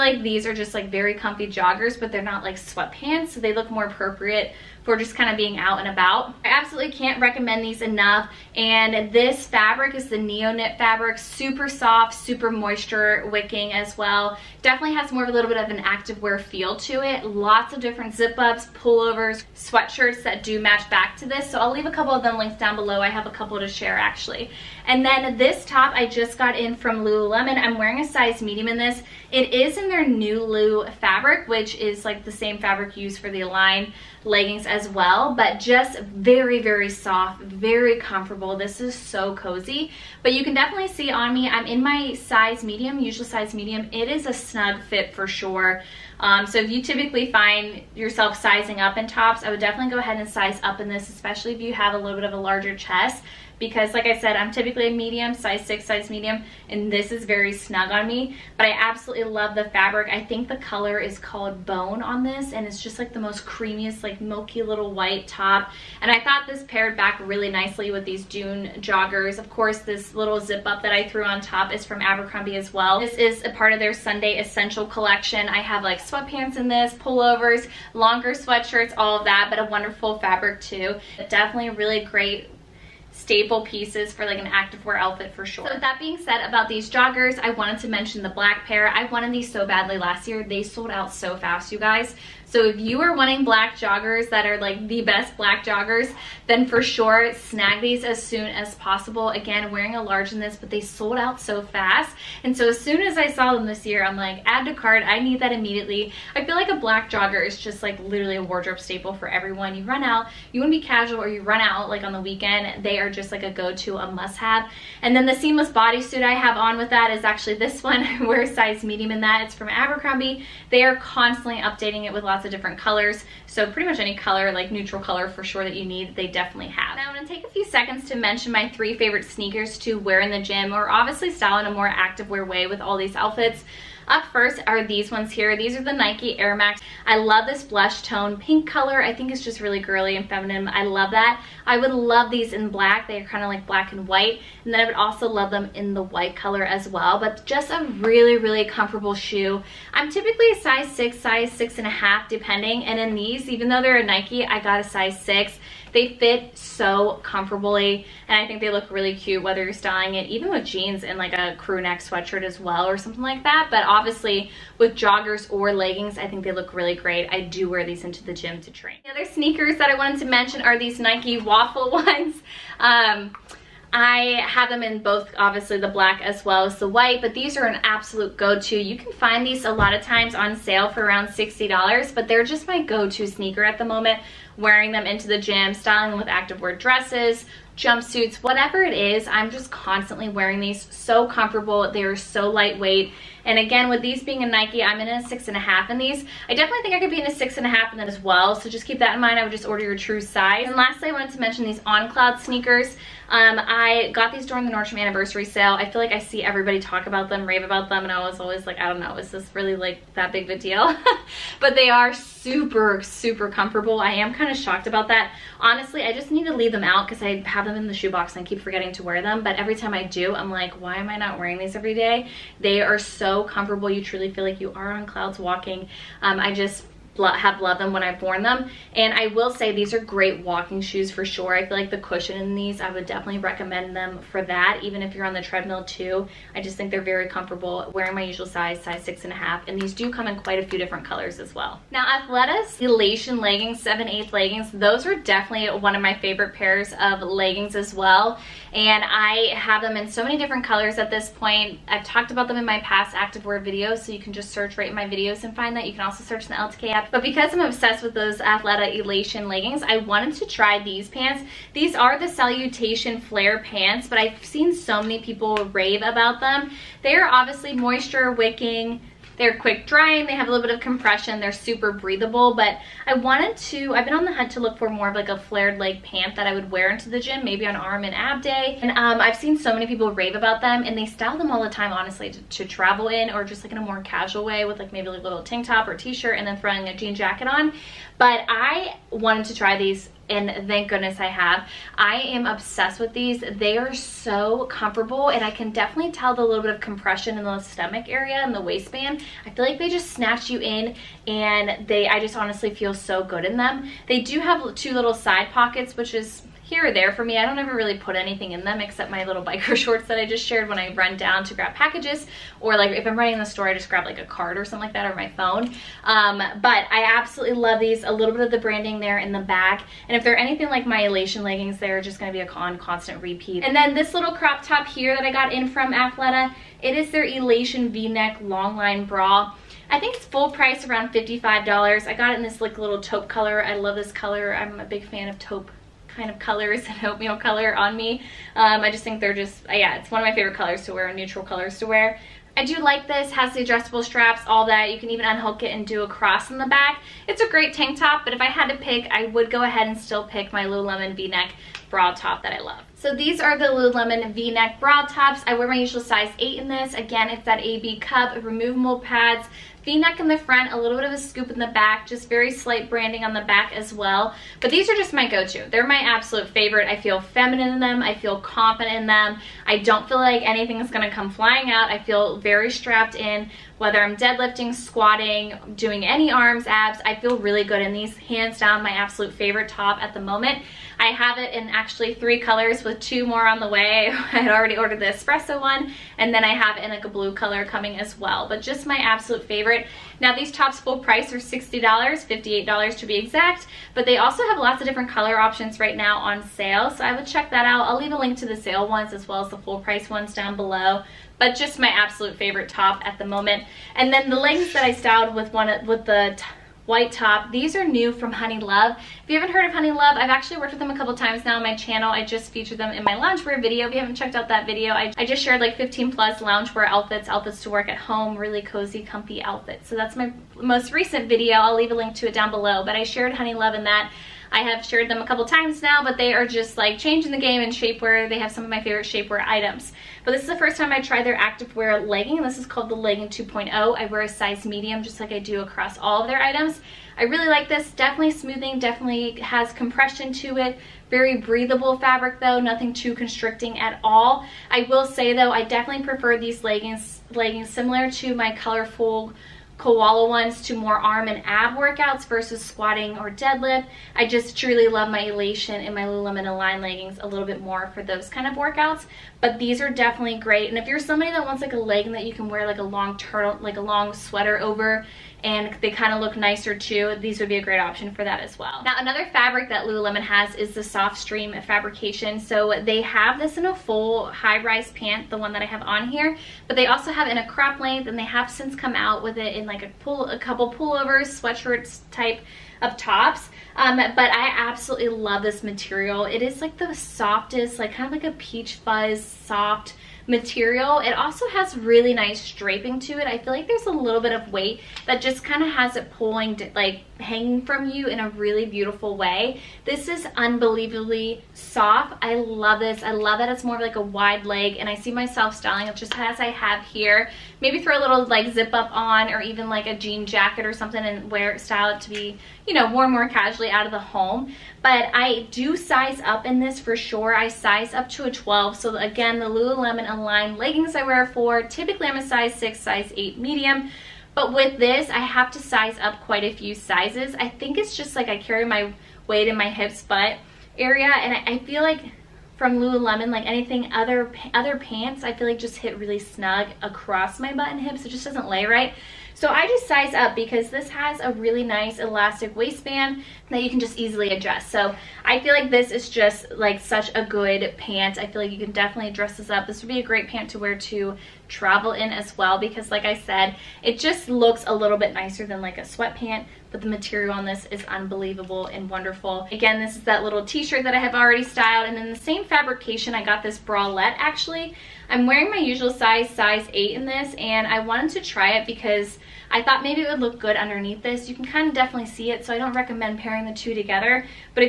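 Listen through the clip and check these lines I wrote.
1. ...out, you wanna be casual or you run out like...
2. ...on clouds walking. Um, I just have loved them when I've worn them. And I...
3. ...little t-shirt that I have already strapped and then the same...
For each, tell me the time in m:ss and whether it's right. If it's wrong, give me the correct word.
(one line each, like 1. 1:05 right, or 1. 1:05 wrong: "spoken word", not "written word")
1. 1:50 right
2. 3:44 right
3. 9:20 wrong: "styled", not "strapped".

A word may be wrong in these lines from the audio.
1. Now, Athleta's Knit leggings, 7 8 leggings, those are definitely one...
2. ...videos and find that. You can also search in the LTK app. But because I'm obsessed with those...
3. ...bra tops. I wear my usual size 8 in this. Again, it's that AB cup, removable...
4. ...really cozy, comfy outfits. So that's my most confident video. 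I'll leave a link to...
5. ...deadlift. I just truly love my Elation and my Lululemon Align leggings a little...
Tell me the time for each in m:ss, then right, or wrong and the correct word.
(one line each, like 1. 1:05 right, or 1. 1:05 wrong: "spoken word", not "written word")
1. 4:01 wrong: "Elation", not "Knit"
2. 4:15 right
3. 5:54 right
4. 6:58 wrong: "recent", not "confident"
5. 7:33 right.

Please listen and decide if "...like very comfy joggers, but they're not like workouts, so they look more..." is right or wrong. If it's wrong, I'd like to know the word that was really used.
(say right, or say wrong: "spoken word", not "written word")
wrong: "sweatpants", not "workouts".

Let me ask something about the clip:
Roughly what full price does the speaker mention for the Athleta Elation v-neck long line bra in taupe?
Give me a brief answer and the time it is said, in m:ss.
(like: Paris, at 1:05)
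$55, at 5:31.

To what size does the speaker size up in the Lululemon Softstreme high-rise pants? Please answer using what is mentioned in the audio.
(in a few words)
12.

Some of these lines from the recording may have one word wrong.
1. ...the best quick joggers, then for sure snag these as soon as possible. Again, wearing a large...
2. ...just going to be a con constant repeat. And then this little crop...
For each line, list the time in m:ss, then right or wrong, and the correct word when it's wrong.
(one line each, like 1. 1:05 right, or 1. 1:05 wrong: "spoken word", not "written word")
1. 1:34 wrong: "black", not "quick"
2. 5:21 right.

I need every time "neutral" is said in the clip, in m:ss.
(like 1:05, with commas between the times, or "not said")
2:04, 5:41.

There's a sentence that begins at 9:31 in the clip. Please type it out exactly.
You can kind of definitely see it, so I don't recommend pairing the two together.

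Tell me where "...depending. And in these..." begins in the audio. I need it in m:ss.
2:32.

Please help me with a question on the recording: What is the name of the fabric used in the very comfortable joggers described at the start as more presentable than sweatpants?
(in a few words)
Neo Knit.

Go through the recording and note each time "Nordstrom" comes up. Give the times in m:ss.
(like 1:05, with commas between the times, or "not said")
3:24.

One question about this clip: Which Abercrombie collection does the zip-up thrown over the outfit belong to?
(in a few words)
Sunday Essential.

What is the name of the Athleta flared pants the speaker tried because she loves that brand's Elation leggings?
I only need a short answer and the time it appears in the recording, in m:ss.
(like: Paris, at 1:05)
Salutation Flare, at 4:22.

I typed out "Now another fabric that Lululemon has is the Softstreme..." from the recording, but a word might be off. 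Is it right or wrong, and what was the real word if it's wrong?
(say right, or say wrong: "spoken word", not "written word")
right.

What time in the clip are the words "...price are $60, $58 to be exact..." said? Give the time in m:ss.
6:30.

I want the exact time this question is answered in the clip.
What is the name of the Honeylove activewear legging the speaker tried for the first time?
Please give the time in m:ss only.
7:12.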